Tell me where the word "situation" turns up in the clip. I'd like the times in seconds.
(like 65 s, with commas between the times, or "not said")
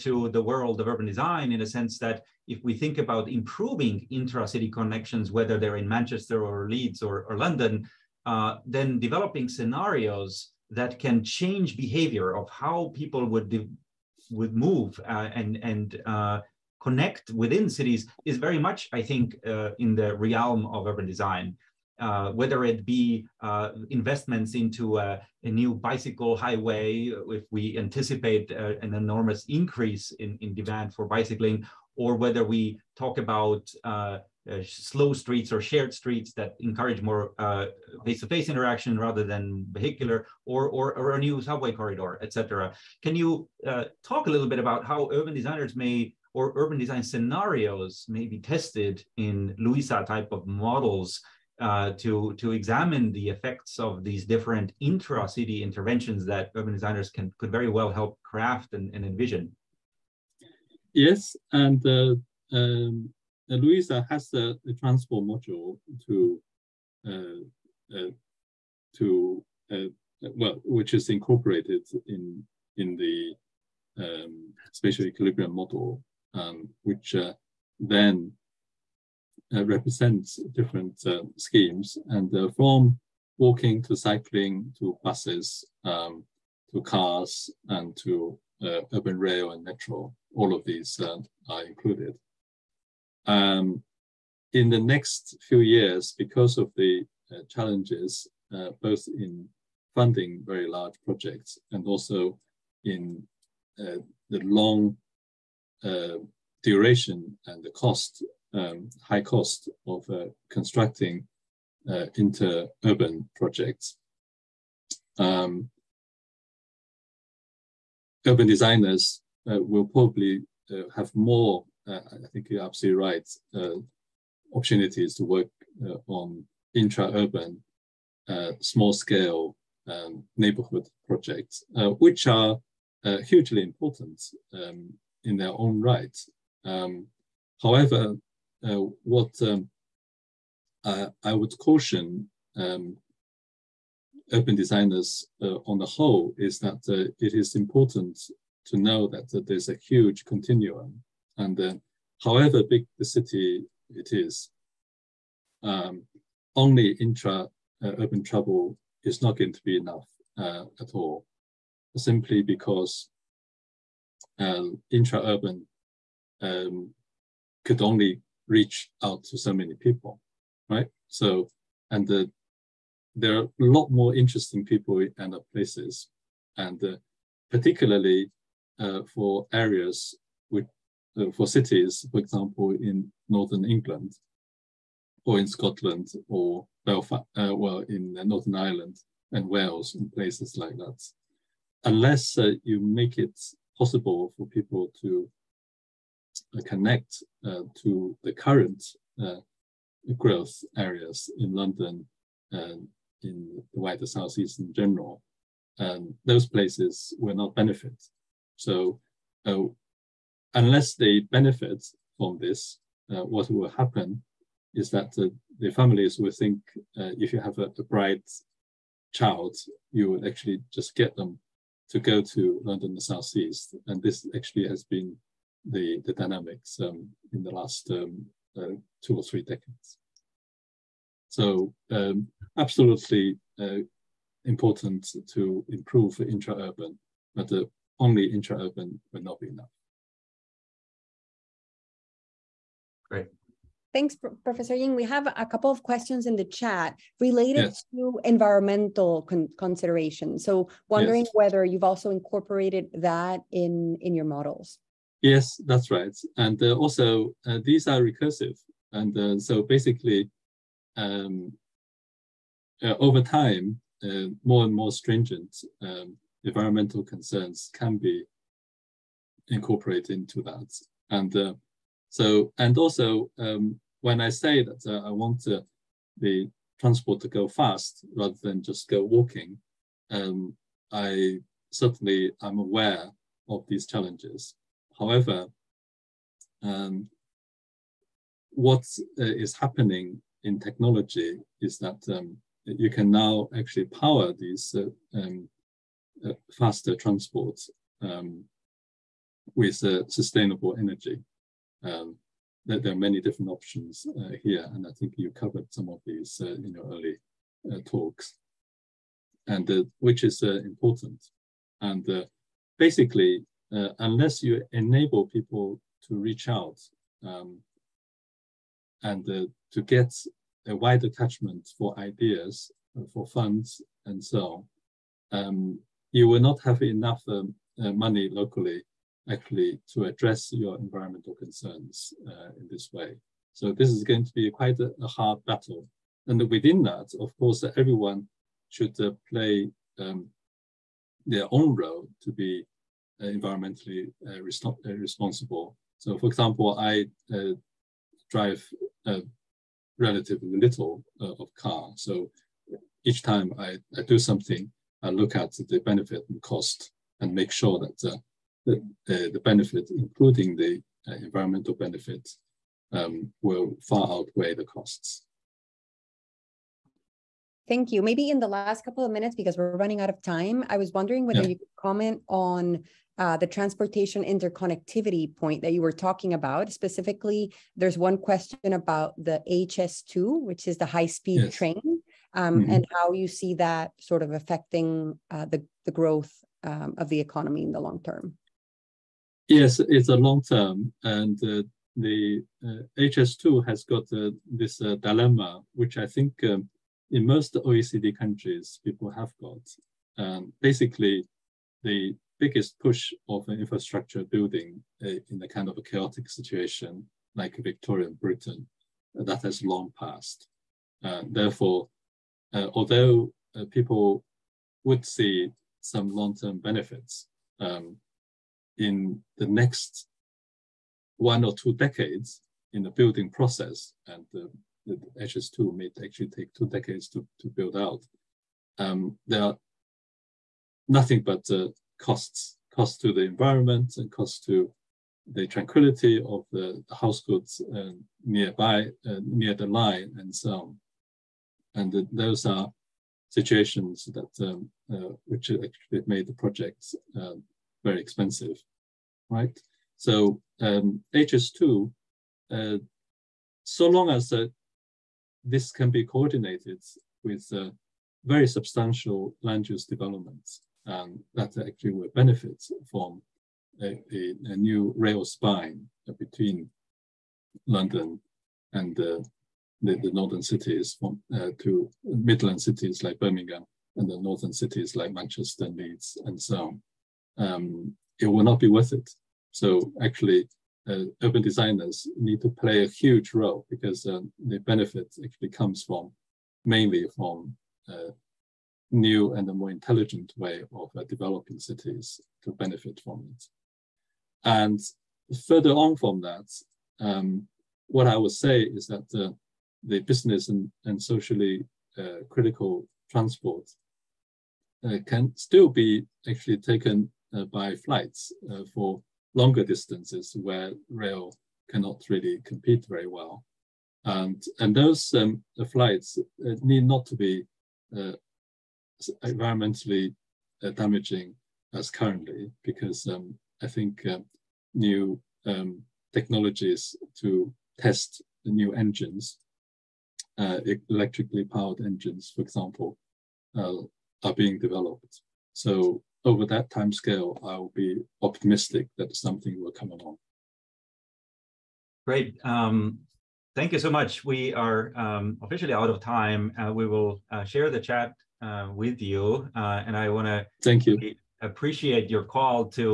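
406 s, 443 s.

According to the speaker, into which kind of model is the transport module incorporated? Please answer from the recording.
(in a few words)
Spatial equilibrium model.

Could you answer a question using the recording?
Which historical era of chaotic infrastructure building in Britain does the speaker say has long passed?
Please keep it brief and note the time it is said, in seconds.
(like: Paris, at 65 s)
Victorian Britain, at 407 s.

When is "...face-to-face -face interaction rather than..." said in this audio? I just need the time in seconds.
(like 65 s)
38 s.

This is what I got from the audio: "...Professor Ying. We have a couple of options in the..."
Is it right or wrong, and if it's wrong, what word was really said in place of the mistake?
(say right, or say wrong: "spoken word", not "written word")
wrong: "questions", not "options".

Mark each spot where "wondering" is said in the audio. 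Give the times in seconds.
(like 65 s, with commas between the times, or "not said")
250 s, 370 s.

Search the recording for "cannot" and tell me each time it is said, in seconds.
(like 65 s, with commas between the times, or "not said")
511 s.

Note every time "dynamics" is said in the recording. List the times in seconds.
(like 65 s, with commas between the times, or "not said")
226 s.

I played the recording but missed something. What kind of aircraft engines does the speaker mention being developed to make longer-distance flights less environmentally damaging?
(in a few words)
Electrically powered engines.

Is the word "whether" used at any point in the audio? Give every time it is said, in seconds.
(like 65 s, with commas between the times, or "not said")
5 s, 22 s, 32 s, 251 s, 371 s.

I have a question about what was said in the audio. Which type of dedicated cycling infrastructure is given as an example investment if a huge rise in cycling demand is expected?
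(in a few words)
Bicycle highway.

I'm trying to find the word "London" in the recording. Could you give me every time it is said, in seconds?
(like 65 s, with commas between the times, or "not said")
7 s, 201 s, 222 s, 467 s.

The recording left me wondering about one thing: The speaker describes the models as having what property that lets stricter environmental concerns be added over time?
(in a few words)
Recursive.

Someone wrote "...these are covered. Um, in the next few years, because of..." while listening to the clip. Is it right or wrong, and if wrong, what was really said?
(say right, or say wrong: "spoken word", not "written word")
wrong: "included", not "covered".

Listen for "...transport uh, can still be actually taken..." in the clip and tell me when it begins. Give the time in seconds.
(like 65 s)
503 s.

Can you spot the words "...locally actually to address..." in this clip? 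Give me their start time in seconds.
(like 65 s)
328 s.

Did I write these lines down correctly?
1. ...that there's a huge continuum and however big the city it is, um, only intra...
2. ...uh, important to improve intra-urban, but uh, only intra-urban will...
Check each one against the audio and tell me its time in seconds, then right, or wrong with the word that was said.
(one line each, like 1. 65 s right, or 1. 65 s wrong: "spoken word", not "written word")
1. 149 s right
2. 233 s right.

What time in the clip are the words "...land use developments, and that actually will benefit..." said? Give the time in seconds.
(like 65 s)
459 s.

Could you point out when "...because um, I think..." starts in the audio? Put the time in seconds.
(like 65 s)
522 s.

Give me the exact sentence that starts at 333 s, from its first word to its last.
So this is going to be quite a, a hard battle.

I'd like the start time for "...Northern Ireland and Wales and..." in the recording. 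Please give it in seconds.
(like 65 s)
188 s.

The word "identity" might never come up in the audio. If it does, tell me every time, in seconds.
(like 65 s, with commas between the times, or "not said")
not said.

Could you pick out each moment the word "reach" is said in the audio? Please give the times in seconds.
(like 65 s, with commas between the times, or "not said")
168 s, 316 s.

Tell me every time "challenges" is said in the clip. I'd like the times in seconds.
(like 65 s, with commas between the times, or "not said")
97 s, 283 s.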